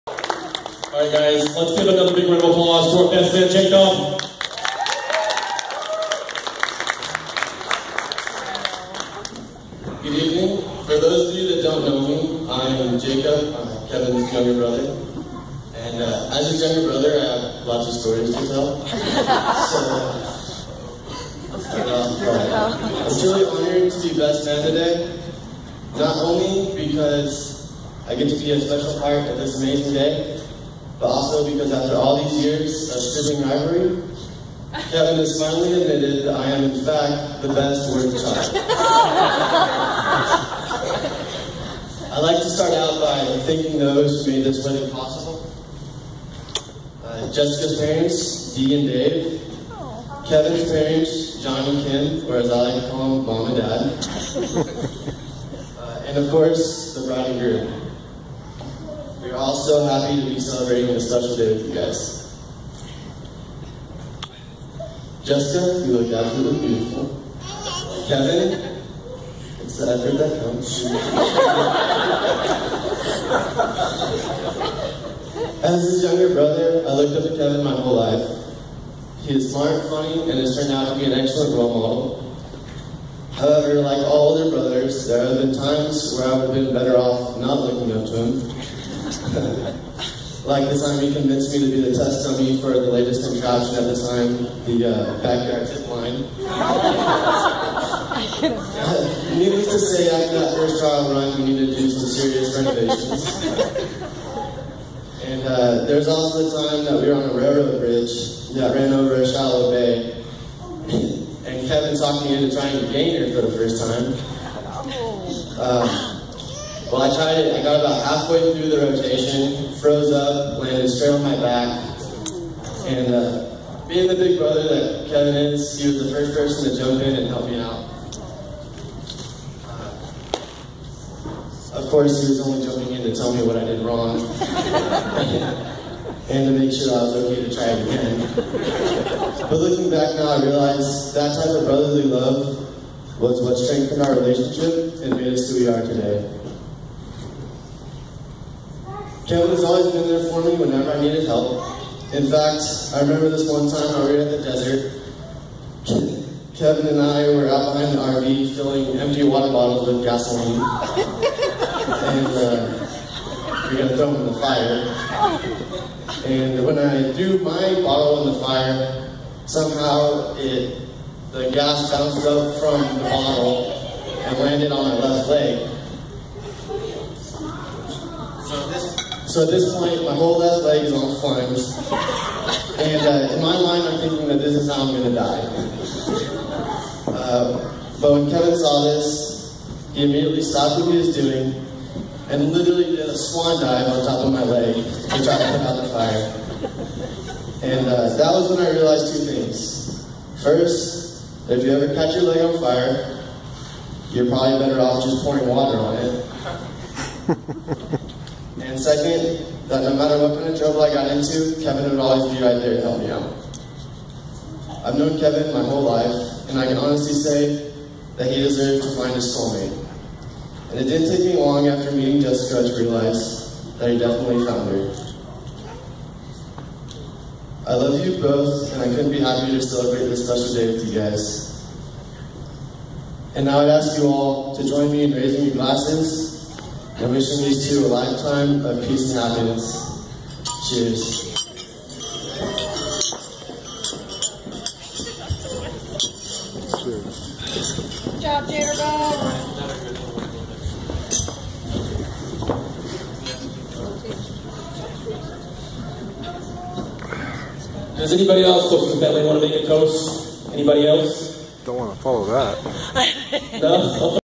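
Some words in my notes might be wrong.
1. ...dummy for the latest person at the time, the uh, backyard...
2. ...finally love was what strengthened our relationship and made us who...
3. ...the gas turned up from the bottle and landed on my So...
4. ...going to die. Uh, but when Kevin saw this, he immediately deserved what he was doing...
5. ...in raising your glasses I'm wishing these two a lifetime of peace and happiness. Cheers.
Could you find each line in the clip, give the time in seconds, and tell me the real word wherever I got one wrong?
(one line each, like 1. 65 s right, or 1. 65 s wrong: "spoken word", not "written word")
1. 92 s wrong: "contraption", not "person"
2. 141 s wrong: "brotherly", not "finally"
3. 171 s wrong: "bounced", not "turned"
4. 184 s wrong: "stopped", not "deserved"
5. 235 s right.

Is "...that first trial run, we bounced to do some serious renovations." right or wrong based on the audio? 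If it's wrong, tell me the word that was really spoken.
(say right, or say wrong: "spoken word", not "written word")
wrong: "needed", not "bounced".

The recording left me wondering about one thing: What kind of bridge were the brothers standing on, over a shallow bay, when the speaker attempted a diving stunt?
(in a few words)
railroad bridge.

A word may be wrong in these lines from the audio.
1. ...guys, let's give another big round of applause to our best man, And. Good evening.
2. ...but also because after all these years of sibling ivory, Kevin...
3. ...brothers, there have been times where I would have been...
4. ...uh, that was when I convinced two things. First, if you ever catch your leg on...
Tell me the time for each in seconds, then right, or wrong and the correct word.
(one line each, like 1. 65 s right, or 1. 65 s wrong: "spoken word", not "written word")
1. 1 s wrong: "Jacob", not "And"
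2. 31 s right
3. 84 s right
4. 197 s wrong: "realized", not "convinced".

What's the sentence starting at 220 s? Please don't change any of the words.
And it didn't take me long after meeting Jessica to realize that he definitely found her.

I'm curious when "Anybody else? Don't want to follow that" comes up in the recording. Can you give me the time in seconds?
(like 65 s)
260 s.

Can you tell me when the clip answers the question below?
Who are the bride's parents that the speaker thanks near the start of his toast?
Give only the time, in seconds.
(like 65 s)
48 s.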